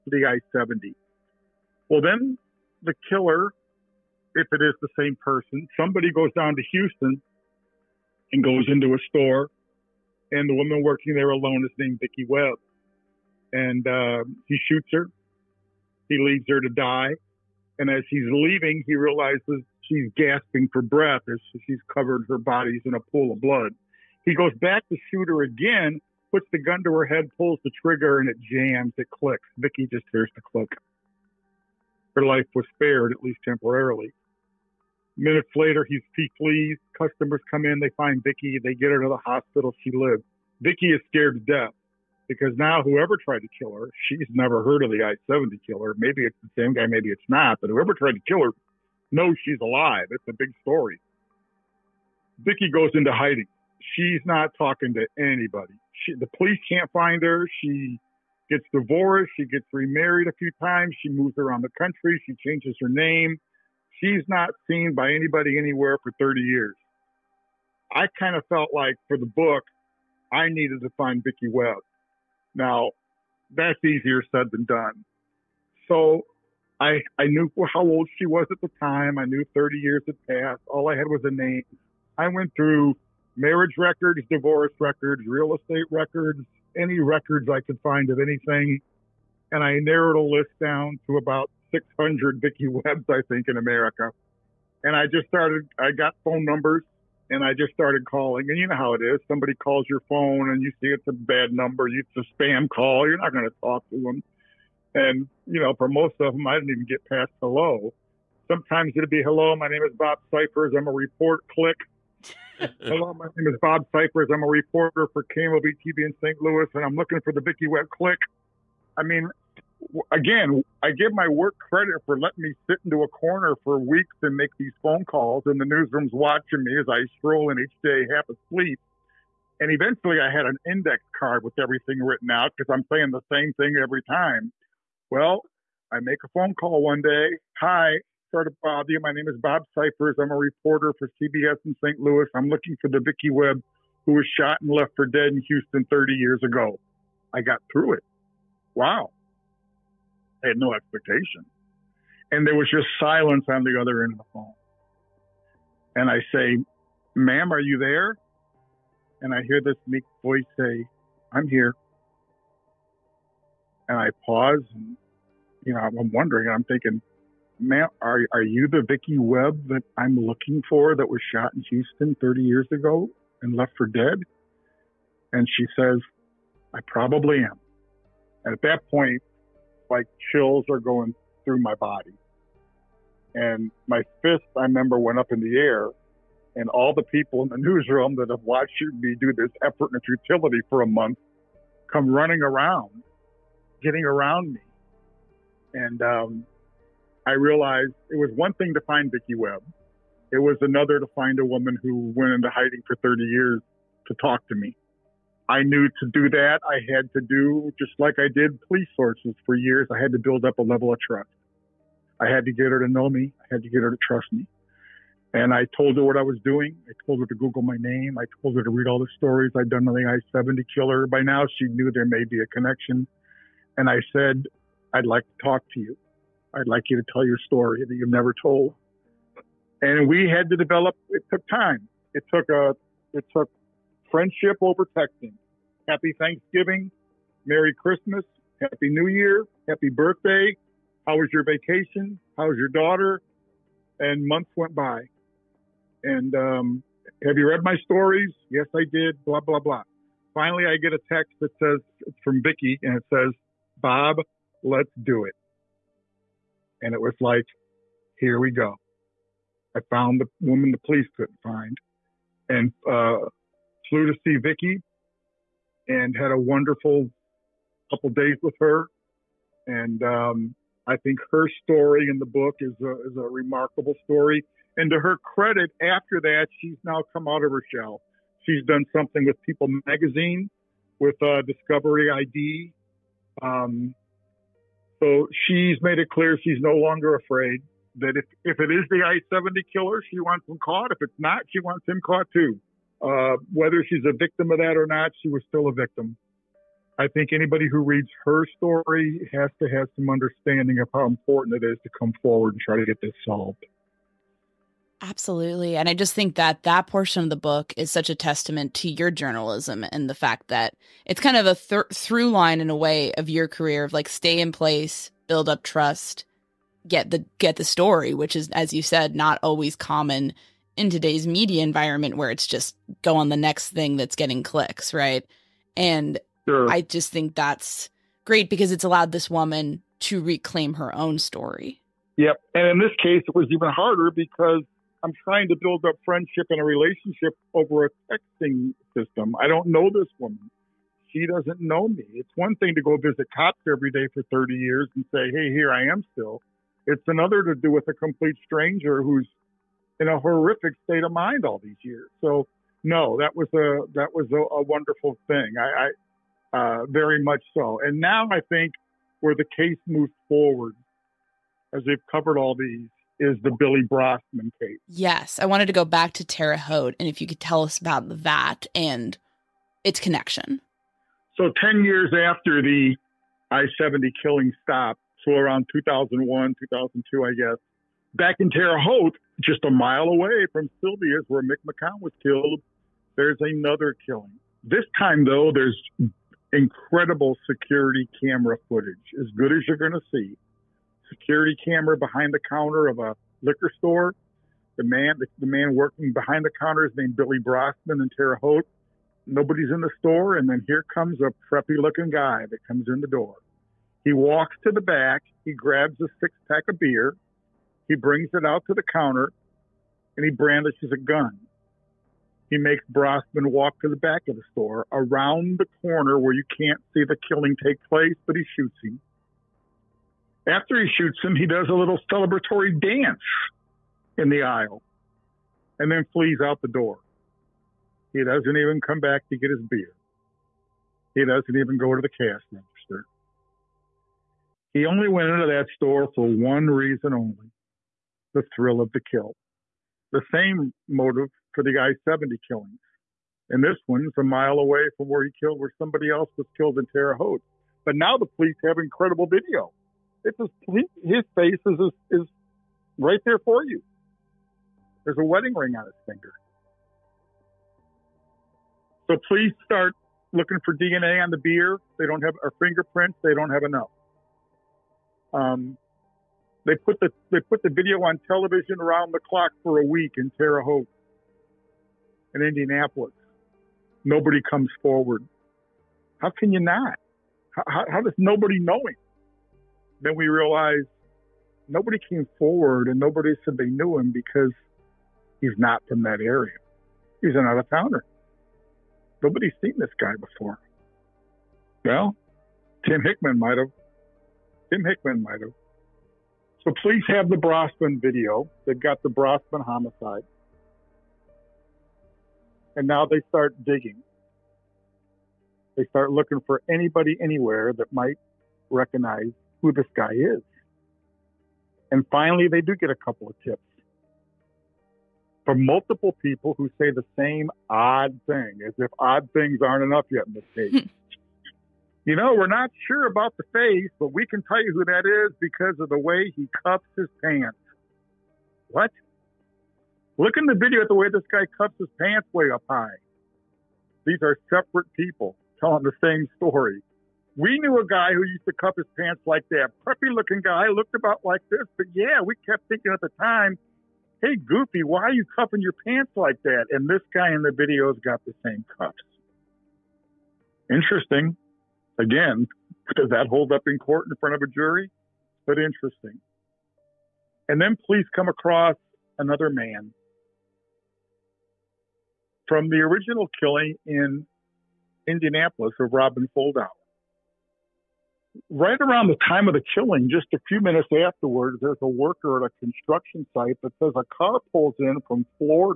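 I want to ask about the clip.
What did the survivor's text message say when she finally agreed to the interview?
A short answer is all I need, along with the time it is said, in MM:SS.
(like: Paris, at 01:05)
Bob, let's do it, at 04:13.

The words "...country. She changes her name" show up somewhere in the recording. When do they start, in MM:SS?
01:01.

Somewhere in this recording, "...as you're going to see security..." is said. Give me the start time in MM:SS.
06:29.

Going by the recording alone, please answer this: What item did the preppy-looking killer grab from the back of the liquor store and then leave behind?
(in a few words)
six-pack of beer.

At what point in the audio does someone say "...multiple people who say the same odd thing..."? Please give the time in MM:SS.
08:35.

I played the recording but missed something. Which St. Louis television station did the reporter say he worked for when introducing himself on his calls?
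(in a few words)
KMOV.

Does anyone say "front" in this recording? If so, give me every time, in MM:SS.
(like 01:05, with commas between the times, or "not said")
09:14.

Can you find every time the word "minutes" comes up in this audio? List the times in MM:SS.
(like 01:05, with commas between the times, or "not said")
00:35, 09:30.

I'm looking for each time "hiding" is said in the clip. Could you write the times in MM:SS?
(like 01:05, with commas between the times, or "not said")
00:53, 03:22.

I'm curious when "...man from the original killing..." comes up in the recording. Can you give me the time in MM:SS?
09:19.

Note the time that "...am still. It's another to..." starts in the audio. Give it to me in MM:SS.
05:45.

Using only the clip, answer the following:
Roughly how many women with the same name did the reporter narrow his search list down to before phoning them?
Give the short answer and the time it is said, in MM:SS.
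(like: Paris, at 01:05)
600, at 01:31.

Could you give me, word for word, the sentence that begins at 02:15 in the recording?
Well, I make a phone call one day.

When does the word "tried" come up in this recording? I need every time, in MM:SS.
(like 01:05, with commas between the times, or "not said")
00:43, 00:47.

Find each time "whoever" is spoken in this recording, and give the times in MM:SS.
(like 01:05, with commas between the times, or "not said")
00:42, 00:47.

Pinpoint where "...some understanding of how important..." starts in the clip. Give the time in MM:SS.
04:59.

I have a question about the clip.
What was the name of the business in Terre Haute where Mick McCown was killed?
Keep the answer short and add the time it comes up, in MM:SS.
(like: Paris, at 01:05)
Sylvia's, at 06:20.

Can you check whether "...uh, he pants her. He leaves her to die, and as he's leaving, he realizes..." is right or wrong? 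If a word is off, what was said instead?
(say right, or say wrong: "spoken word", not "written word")
wrong: "shoots", not "pants".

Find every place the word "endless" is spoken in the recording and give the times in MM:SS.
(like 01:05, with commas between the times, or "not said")
not said.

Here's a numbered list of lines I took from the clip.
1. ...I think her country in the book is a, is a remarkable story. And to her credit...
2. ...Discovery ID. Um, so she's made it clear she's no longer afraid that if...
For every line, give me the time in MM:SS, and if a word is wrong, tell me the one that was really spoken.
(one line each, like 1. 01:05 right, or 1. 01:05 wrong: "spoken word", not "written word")
1. 04:30 wrong: "story", not "country"
2. 04:41 right.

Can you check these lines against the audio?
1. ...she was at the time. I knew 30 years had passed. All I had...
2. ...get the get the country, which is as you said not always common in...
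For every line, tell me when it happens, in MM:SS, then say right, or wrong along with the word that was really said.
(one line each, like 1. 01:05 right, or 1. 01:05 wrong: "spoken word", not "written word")
1. 01:18 right
2. 05:16 wrong: "story", not "country".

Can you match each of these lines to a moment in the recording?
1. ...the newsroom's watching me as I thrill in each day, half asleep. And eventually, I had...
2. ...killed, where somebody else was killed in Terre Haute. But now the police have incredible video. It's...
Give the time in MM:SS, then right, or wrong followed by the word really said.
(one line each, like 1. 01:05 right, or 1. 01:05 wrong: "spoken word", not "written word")
1. 02:05 wrong: "stroll", not "thrill"
2. 07:25 right.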